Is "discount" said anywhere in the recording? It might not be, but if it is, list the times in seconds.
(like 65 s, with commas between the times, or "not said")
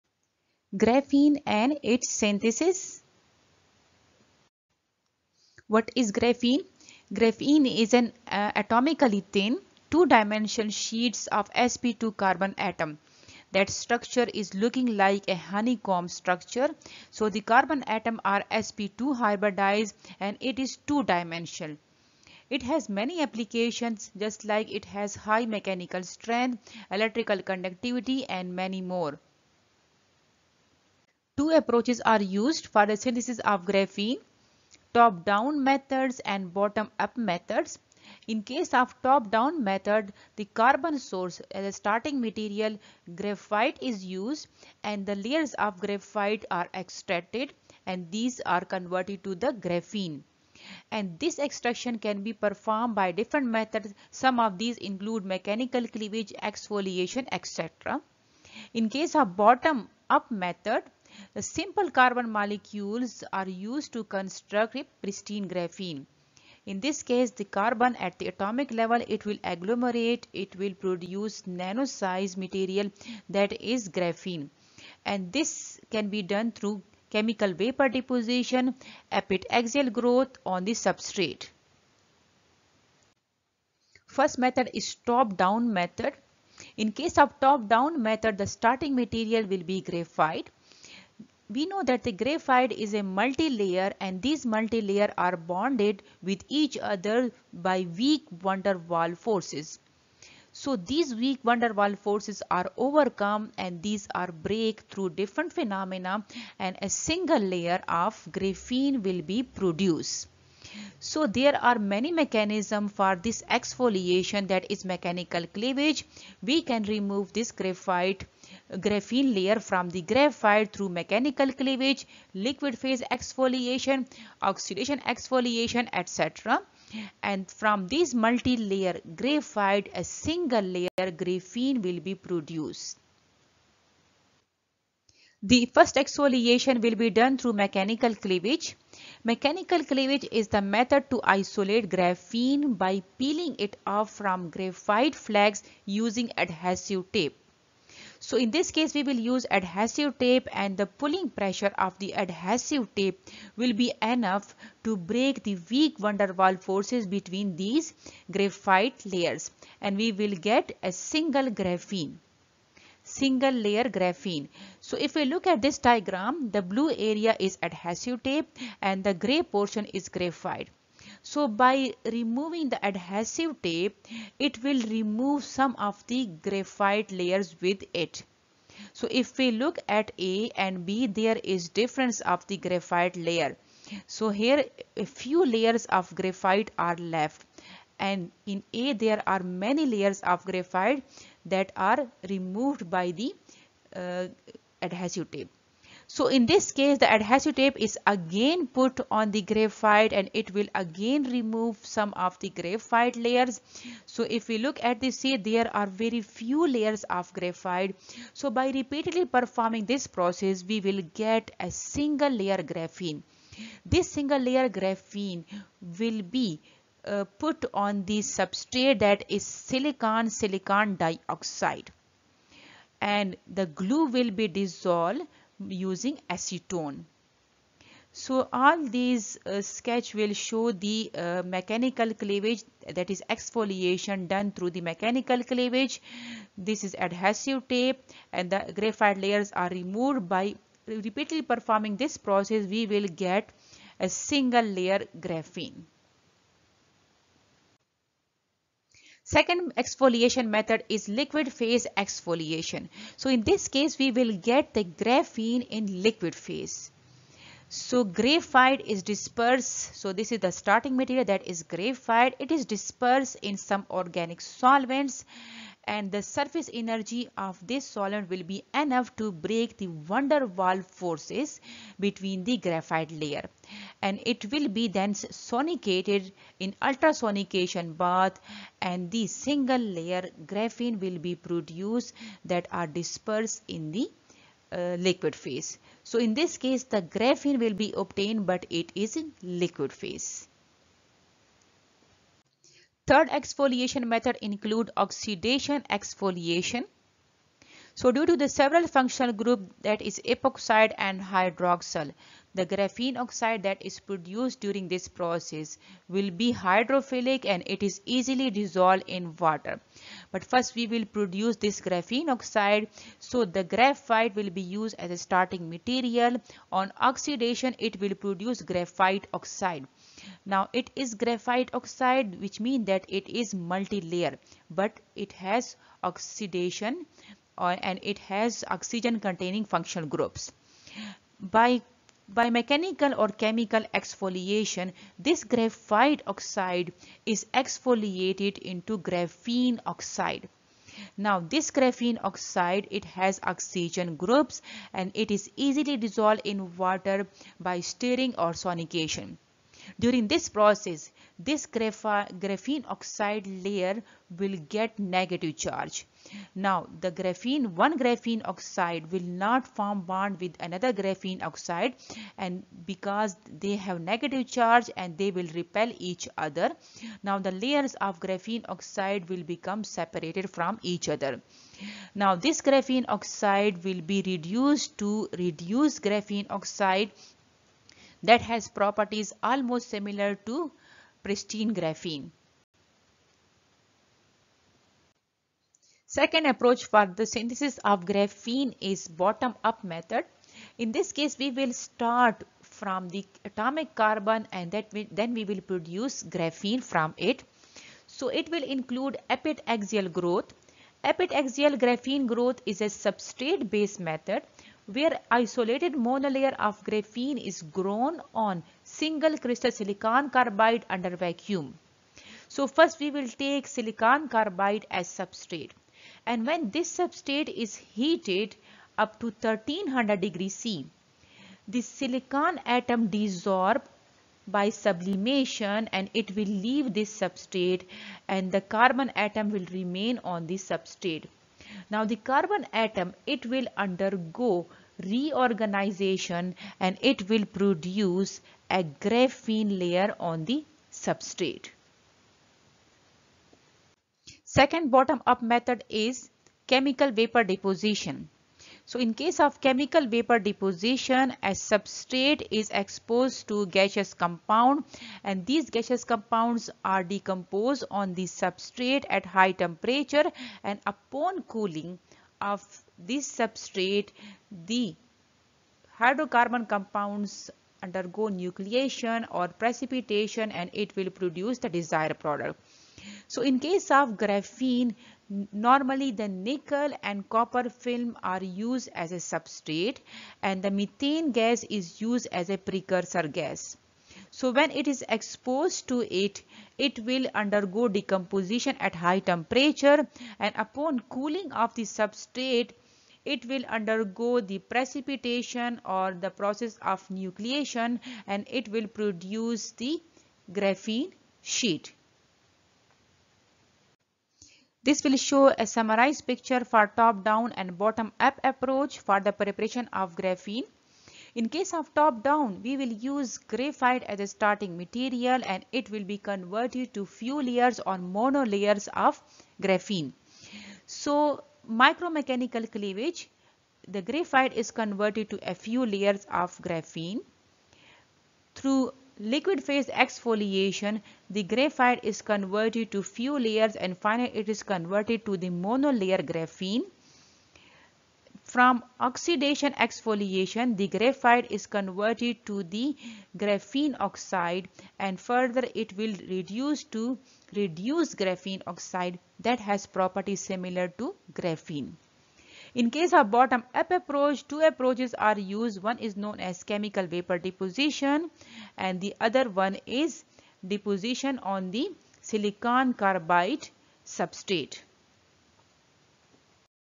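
not said.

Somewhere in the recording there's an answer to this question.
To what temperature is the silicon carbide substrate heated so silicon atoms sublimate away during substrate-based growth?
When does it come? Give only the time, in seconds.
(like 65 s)
419 s.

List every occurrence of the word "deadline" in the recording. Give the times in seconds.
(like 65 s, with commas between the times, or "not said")
not said.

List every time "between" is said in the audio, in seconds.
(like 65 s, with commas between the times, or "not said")
157 s, 271 s.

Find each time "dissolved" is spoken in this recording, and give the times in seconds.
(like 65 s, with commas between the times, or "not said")
224 s, 308 s, 345 s.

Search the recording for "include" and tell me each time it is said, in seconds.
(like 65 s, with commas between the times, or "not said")
54 s, 294 s, 398 s.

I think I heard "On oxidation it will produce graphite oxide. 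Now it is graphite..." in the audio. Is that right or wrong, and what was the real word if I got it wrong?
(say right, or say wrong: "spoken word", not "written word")
right.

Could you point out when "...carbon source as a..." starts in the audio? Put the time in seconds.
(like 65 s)
40 s.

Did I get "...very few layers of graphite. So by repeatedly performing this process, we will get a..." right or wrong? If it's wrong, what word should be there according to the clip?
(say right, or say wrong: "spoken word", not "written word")
right.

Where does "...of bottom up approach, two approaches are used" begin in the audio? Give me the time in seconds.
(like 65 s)
553 s.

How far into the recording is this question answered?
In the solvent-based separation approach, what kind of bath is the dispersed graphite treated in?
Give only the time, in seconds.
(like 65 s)
276 s.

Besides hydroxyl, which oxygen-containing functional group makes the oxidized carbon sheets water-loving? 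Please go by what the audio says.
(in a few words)
epoxide.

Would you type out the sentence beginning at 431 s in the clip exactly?
Now the carbon atom, it will undergo reorganization and it will produce a graphene layer on the substrate.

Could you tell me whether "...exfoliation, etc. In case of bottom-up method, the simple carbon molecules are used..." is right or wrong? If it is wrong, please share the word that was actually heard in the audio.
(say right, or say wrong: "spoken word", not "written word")
right.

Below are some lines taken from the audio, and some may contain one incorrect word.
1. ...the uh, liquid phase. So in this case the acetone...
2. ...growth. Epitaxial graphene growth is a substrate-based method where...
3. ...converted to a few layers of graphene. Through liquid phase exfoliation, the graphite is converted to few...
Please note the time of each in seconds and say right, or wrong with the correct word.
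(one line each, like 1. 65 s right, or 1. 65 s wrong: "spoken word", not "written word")
1. 283 s wrong: "graphene", not "acetone"
2. 400 s right
3. 524 s right.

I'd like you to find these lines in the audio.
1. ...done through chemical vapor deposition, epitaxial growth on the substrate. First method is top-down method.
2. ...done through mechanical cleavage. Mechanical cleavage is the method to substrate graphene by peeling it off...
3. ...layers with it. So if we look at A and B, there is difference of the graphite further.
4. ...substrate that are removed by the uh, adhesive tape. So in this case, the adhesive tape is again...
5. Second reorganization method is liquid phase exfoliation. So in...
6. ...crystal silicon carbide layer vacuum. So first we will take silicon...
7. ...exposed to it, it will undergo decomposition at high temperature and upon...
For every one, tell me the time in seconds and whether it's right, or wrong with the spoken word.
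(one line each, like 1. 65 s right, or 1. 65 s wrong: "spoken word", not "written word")
1. 76 s right
2. 137 s wrong: "isolate", not "substrate"
3. 177 s wrong: "layer", not "further"
4. 190 s wrong: "graphite", not "substrate"
5. 249 s wrong: "exfoliation", not "reorganization"
6. 409 s wrong: "under", not "layer"
7. 485 s right.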